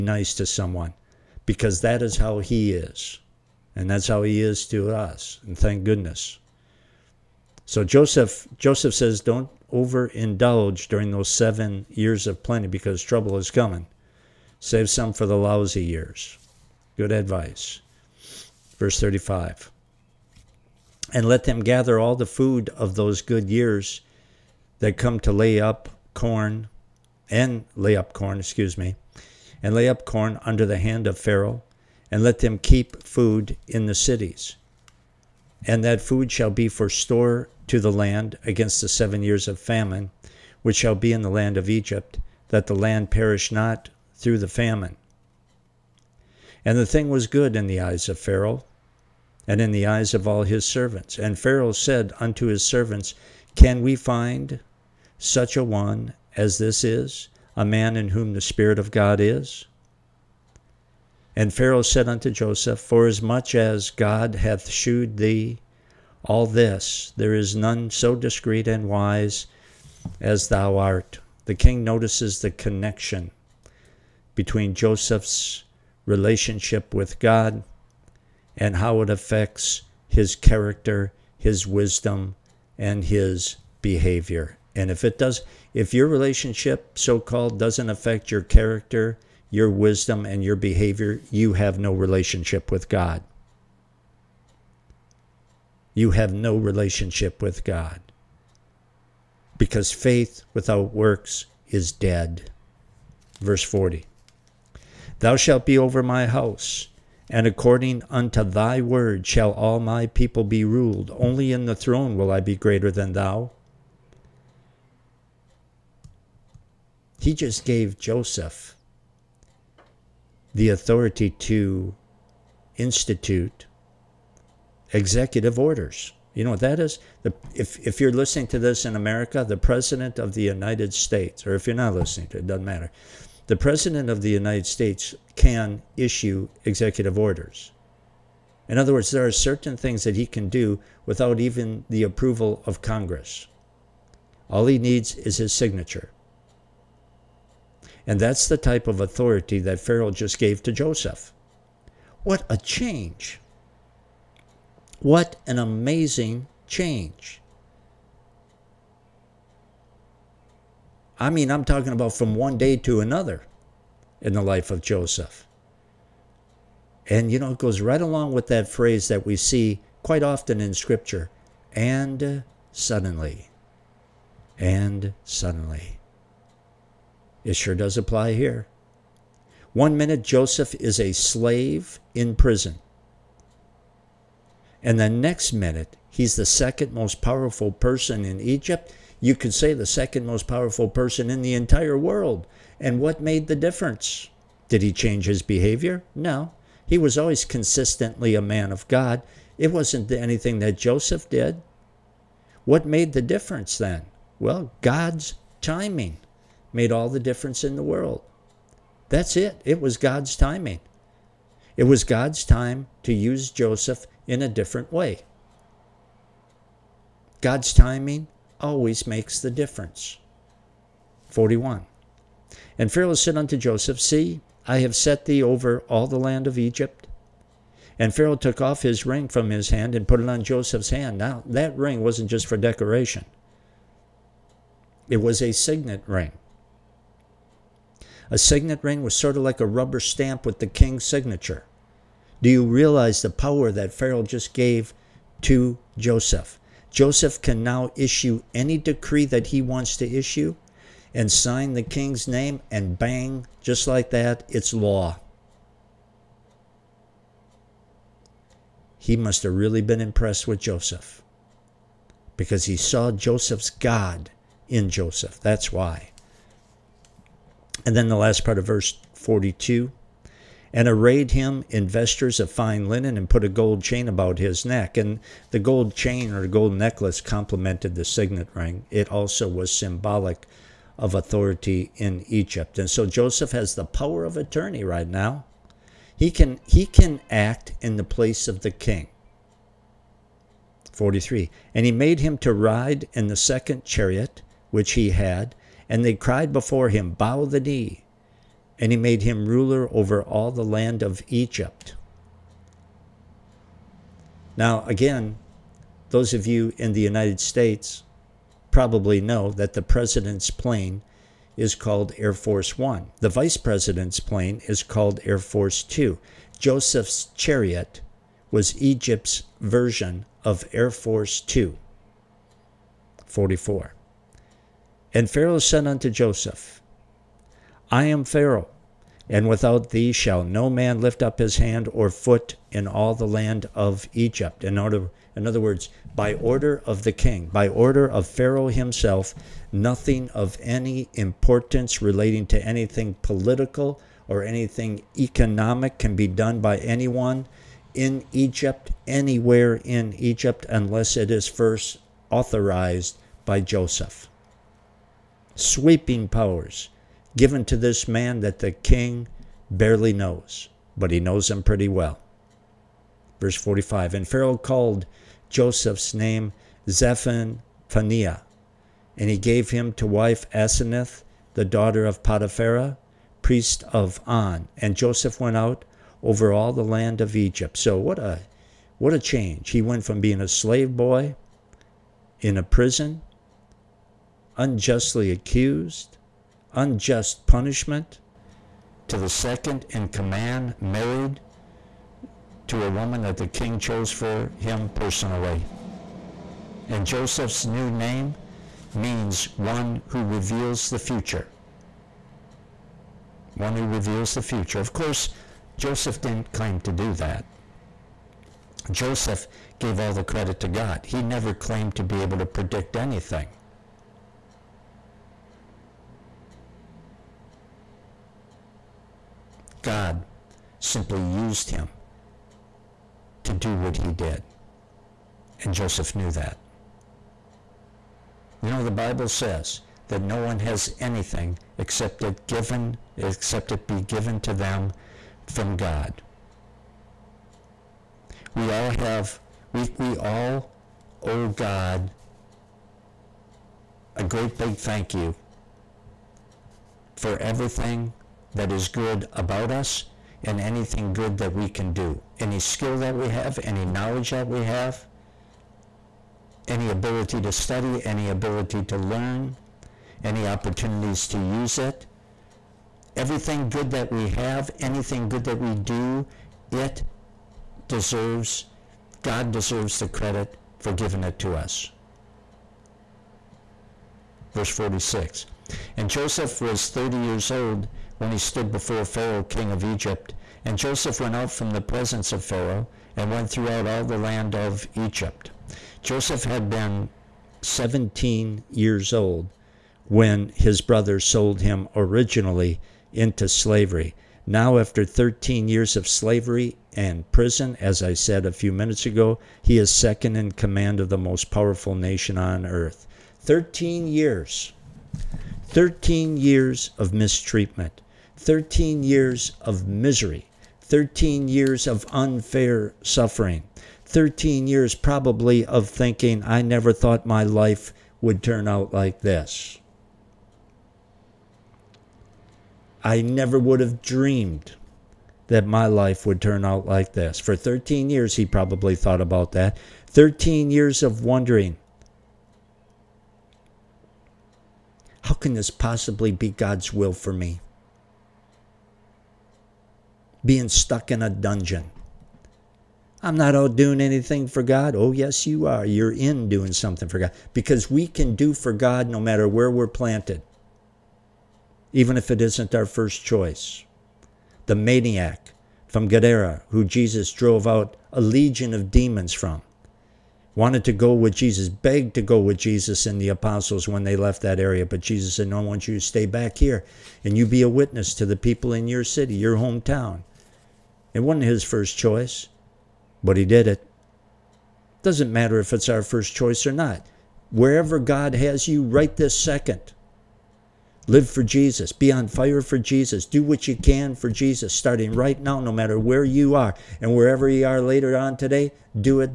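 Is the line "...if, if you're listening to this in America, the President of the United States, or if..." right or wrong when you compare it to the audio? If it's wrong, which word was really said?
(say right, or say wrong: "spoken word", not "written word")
right.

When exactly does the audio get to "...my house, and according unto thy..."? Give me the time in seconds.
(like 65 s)
106 s.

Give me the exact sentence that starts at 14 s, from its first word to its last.
Save some for the lousy years.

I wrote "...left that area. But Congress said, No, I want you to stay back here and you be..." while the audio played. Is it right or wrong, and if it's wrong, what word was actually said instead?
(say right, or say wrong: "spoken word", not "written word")
wrong: "Jesus", not "Congress".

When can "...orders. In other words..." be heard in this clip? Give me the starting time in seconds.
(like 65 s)
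137 s.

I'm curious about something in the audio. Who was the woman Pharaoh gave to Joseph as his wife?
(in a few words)
Aseneth.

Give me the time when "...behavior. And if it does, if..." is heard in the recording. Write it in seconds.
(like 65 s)
83 s.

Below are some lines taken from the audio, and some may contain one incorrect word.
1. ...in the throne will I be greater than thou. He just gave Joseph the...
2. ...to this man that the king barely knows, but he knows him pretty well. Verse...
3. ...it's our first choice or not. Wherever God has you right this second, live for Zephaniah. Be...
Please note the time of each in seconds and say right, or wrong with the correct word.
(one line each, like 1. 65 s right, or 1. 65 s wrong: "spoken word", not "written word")
1. 111 s right
2. 357 s right
3. 575 s wrong: "Jesus", not "Zephaniah".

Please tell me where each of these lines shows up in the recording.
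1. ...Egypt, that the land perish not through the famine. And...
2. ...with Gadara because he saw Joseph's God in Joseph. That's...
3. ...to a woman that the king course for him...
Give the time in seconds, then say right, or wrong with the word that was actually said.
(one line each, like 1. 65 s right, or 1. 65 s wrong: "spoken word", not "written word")
1. 41 s right
2. 260 s wrong: "Joseph", not "Gadara"
3. 392 s wrong: "chose", not "course".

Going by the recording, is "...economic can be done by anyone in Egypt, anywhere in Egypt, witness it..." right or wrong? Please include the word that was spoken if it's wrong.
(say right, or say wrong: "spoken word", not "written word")
wrong: "unless", not "witness".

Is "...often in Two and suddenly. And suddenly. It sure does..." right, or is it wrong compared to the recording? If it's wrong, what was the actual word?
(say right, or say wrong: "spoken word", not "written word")
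wrong: "Scripture", not "Two".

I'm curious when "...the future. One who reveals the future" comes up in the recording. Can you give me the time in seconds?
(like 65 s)
400 s.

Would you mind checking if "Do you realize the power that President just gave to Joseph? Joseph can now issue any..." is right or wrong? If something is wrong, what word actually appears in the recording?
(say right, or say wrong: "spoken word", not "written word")
wrong: "Pharaoh", not "President".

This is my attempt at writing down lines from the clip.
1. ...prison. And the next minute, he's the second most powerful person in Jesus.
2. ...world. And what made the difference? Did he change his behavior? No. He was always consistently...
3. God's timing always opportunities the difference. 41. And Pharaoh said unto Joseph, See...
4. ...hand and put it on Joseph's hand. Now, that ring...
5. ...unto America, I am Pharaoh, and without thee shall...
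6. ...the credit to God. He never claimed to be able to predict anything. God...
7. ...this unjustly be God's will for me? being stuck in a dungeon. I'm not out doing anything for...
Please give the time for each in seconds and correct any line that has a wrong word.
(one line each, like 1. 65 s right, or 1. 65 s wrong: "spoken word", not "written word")
1. 182 s wrong: "Egypt", not "Jesus"
2. 191 s right
3. 217 s wrong: "makes", not "opportunities"
4. 229 s right
5. 325 s wrong: "Joseph", not "America"
6. 410 s right
7. 535 s wrong: "possibly", not "unjustly".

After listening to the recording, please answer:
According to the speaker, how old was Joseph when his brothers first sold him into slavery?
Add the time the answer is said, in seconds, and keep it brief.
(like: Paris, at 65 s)
17, at 487 s.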